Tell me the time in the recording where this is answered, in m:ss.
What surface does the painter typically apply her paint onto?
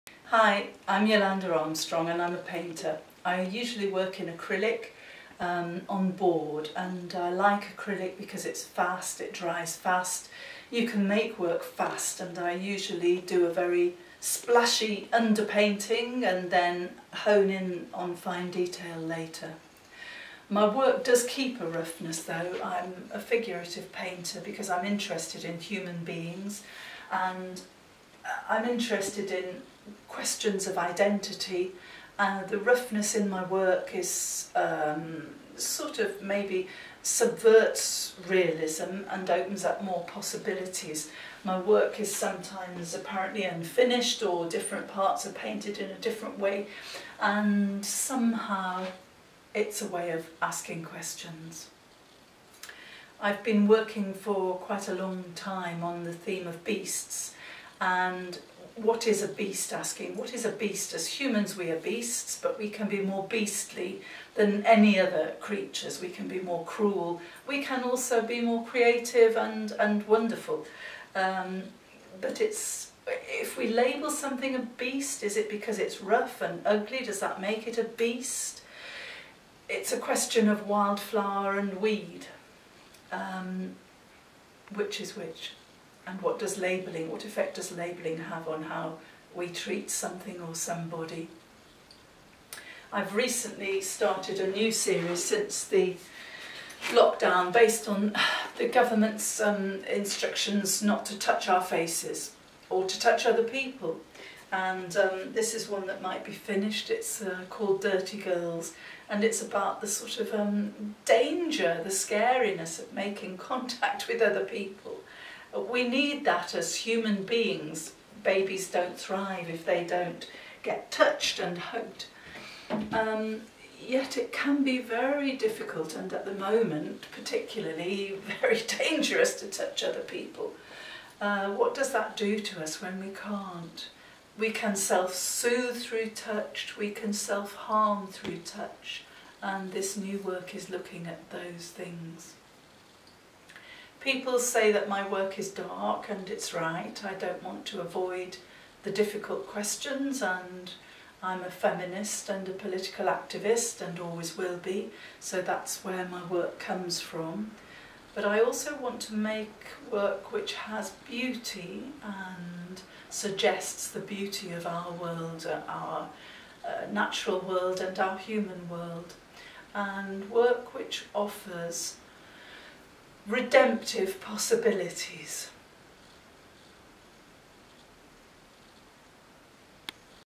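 0:06.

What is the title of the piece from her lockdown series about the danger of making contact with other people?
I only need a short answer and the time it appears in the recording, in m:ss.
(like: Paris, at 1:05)
Dirty Girls, at 1:47.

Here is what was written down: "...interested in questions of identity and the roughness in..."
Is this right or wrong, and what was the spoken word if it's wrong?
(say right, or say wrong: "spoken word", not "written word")
right.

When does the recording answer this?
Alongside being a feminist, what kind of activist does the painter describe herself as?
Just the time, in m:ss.
2:32.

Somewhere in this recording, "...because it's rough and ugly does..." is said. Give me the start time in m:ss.
1:15.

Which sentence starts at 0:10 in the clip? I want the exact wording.
You can make work fast and I usually do a very splashy underpainting and then hone in on fine detail later.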